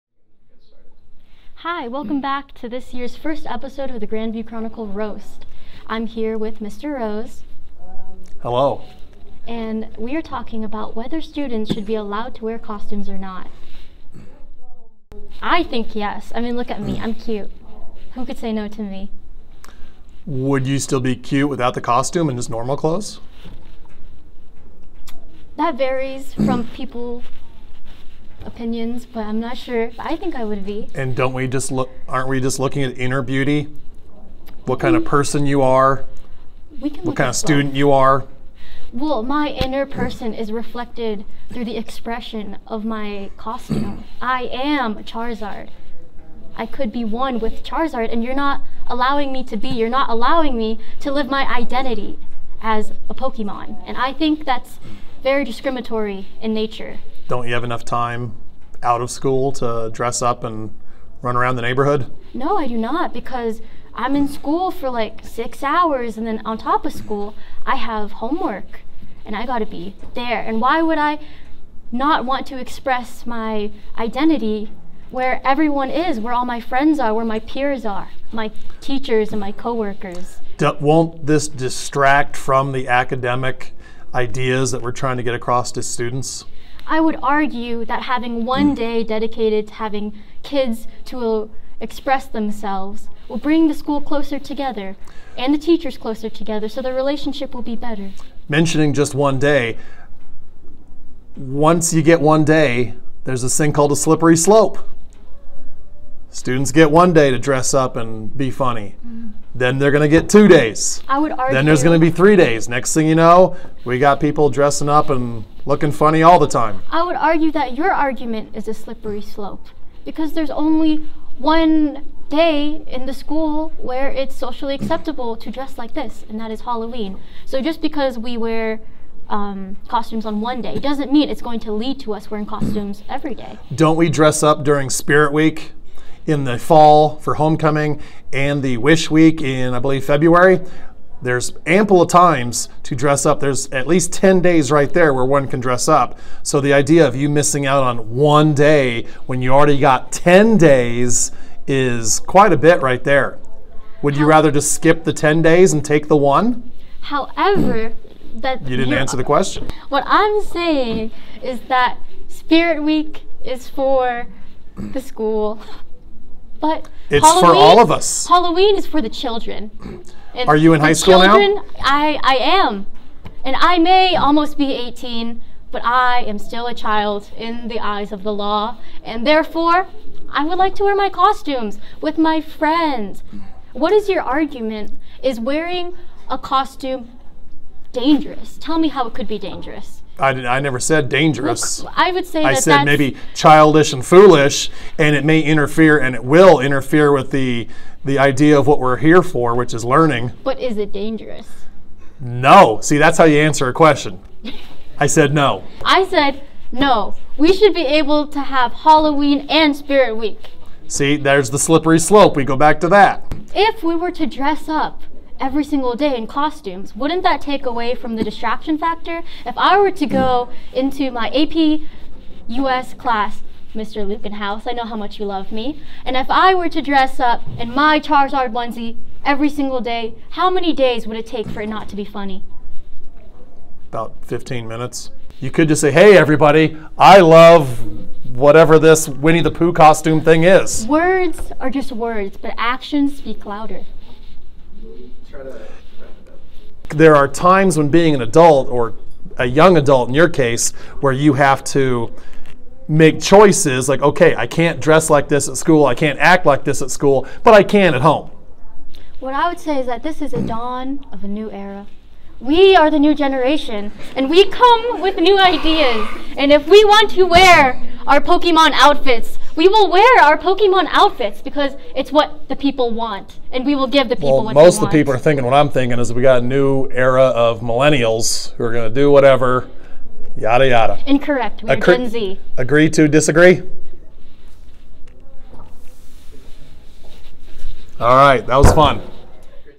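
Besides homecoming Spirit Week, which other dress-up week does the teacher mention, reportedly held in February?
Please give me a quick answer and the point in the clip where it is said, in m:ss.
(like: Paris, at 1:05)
Wish Week, at 2:18.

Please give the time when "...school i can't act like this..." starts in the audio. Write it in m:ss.
4:15.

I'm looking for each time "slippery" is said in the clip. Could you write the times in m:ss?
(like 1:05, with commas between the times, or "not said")
1:43, 1:58, 3:31.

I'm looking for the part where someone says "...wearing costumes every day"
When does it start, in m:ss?
2:12.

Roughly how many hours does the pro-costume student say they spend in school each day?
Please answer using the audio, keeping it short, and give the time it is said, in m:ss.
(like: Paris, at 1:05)
6, at 1:05.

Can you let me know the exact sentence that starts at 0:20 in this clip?
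Would you still be cute without the costume and just normal clothes?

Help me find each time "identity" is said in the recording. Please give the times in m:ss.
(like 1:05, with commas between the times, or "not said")
0:51, 1:13.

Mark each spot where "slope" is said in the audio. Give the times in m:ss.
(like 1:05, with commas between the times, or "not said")
1:44, 1:59, 3:31.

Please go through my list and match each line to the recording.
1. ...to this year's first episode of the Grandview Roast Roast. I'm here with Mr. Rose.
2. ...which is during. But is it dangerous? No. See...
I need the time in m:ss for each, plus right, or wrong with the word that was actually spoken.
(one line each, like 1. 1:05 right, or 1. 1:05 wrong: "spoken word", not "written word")
1. 0:02 wrong: "Chronicle", not "Roast"
2. 3:19 wrong: "learning", not "during".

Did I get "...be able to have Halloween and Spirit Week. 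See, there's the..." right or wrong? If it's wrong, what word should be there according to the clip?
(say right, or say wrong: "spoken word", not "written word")
right.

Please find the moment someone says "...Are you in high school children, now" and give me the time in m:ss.
2:50.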